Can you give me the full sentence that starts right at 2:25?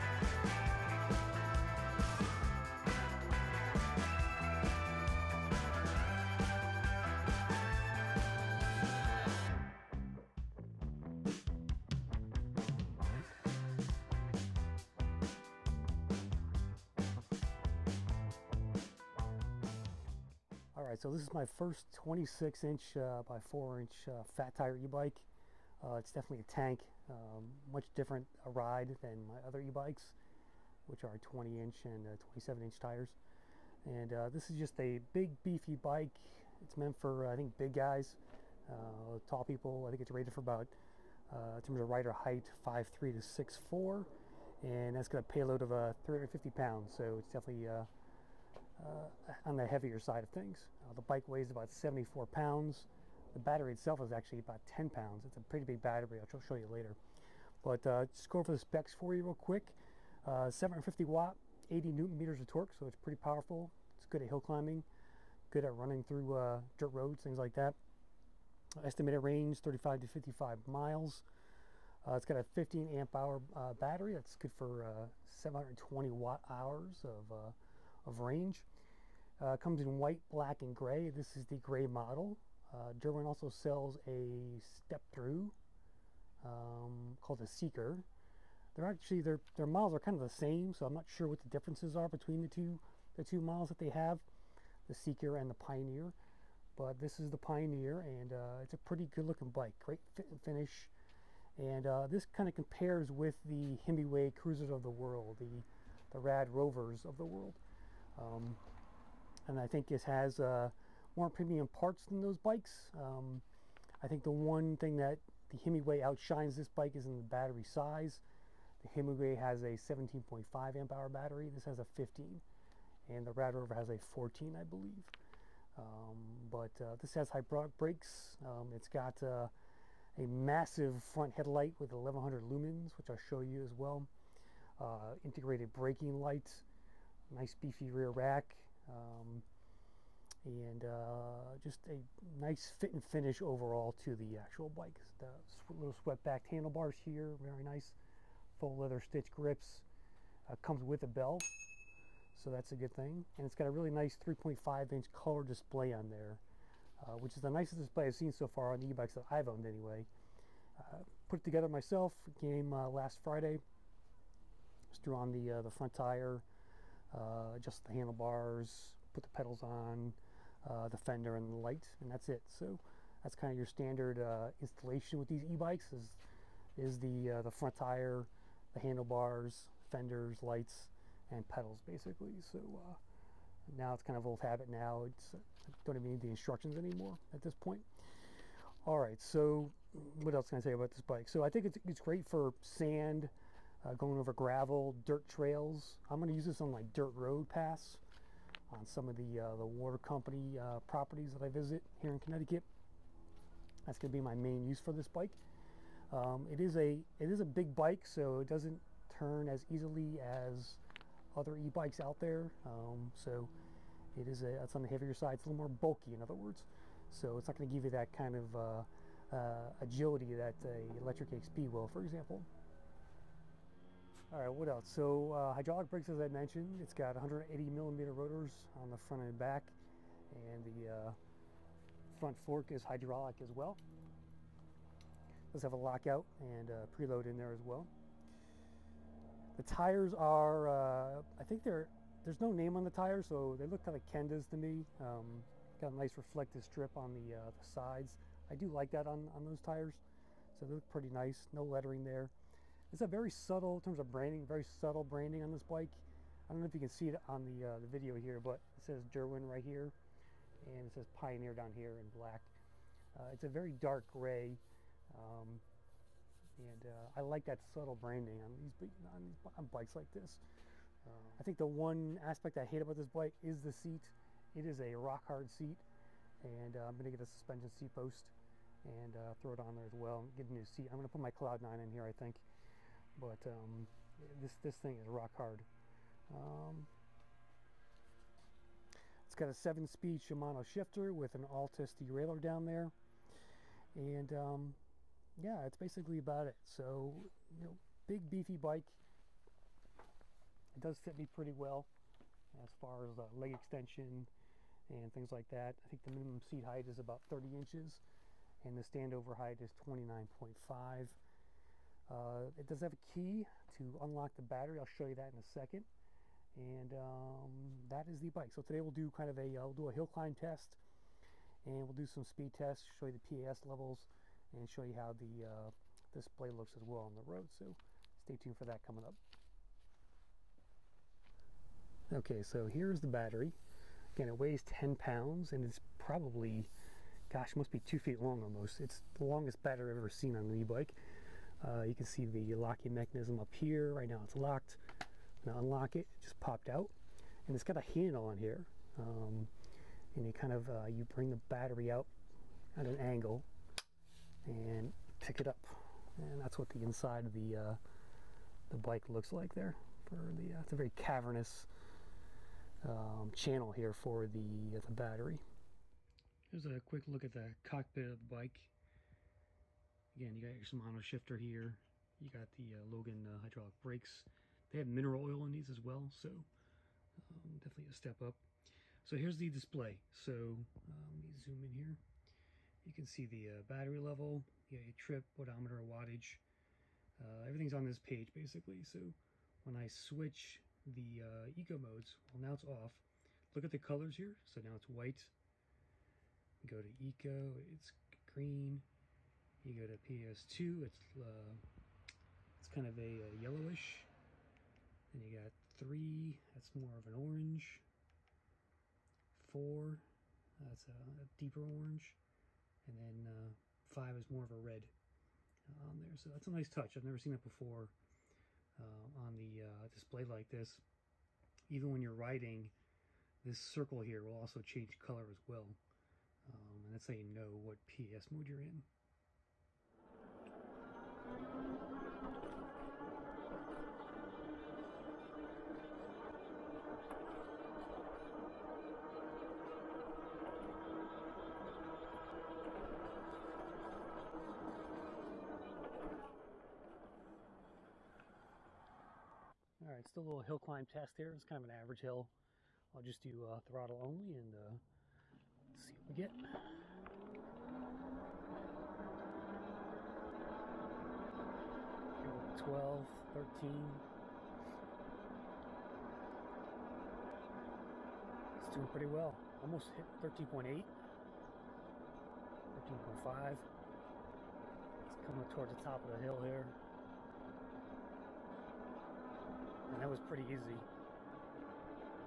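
The little swept back handlebars here, very nice full leather stitch grips.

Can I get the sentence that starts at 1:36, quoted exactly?
But this is the Pioneer, and uh, it's a pretty good-looking bike.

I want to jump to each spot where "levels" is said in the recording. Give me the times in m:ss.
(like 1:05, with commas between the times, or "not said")
5:23, 6:23.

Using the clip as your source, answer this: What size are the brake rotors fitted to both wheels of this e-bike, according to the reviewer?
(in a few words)
180 millimeter.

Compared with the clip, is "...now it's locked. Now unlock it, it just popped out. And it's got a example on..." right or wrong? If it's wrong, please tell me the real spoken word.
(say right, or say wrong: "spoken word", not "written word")
wrong: "handle", not "example".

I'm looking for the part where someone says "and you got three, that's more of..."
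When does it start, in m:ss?
6:45.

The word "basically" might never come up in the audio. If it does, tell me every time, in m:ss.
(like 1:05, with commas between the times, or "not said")
3:01, 4:55, 6:28.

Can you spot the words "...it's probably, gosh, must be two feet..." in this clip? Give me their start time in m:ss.
5:35.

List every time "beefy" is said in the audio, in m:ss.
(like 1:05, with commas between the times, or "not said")
0:35, 2:17, 4:58.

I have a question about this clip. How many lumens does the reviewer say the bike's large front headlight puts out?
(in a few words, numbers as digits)
1100.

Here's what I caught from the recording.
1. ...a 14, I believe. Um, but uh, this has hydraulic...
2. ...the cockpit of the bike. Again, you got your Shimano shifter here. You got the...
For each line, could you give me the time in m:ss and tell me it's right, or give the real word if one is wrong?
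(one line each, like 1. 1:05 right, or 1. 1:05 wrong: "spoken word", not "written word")
1. 2:03 right
2. 6:07 right.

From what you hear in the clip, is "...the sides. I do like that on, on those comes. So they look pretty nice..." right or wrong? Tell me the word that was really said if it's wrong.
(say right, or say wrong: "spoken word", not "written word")
wrong: "tires", not "comes".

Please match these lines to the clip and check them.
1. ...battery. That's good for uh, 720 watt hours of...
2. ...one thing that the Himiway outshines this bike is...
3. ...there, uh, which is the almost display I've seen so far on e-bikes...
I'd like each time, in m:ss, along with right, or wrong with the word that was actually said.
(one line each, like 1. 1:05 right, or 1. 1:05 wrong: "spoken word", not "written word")
1. 1:13 right
2. 1:54 right
3. 2:36 wrong: "nicest", not "almost".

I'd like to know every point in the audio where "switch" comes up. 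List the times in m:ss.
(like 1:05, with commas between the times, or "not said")
6:29.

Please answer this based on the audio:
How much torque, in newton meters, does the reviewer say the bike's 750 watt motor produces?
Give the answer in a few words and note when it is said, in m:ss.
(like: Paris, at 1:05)
80 newton meters, at 1:01.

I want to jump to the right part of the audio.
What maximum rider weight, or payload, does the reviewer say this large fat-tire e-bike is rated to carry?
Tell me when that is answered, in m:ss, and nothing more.
0:45.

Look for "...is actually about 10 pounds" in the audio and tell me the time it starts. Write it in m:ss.
0:54.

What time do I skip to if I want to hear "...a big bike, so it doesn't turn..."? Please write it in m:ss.
3:27.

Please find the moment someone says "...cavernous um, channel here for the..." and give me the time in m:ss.
6:00.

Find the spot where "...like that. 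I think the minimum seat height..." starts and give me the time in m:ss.
5:05.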